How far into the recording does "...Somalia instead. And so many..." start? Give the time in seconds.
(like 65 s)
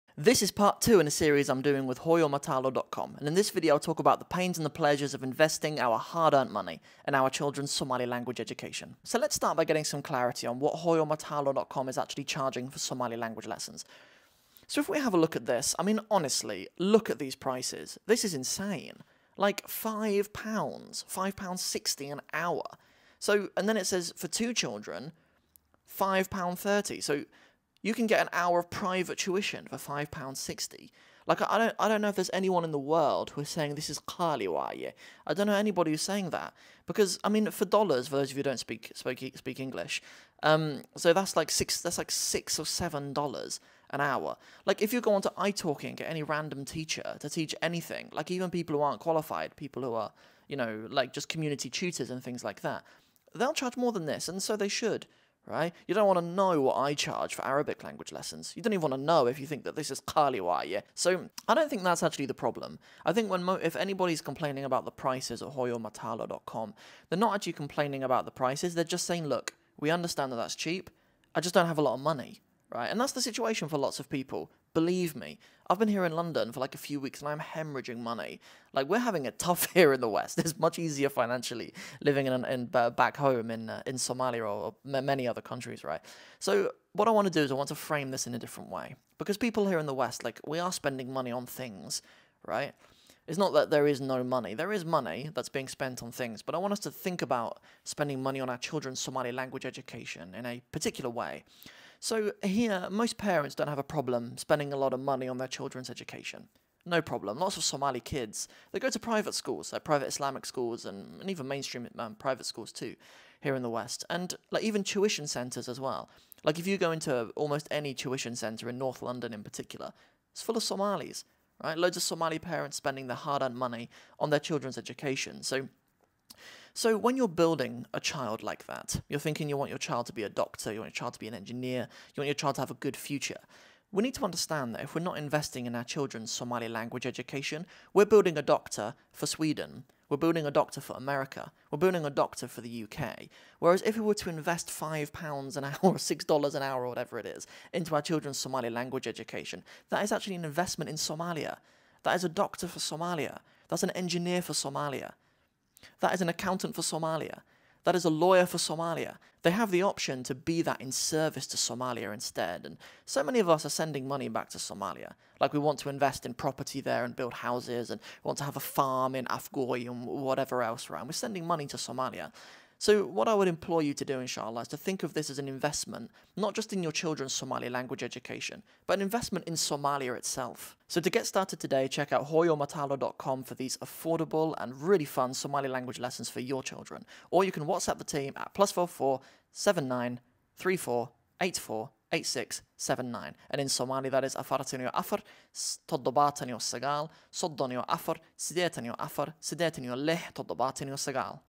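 161 s.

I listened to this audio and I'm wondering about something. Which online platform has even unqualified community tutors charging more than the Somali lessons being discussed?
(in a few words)
italki.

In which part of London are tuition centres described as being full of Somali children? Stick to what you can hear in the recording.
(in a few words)
North London.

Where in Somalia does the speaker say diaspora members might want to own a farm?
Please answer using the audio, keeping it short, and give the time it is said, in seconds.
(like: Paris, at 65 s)
Afgooye, at 169 s.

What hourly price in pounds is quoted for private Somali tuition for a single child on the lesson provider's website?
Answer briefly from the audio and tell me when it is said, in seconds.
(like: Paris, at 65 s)
£5.60, at 21 s.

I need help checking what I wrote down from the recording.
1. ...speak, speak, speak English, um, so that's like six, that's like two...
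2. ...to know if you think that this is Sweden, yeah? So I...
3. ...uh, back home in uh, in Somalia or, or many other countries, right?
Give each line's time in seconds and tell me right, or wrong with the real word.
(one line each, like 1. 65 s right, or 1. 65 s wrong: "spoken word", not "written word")
1. 38 s wrong: "six", not "two"
2. 58 s wrong: "Kaliwa", not "Sweden"
3. 82 s right.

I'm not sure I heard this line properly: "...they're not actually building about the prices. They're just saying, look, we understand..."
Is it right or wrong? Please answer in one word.
wrong.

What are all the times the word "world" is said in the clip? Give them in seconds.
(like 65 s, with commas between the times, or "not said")
32 s.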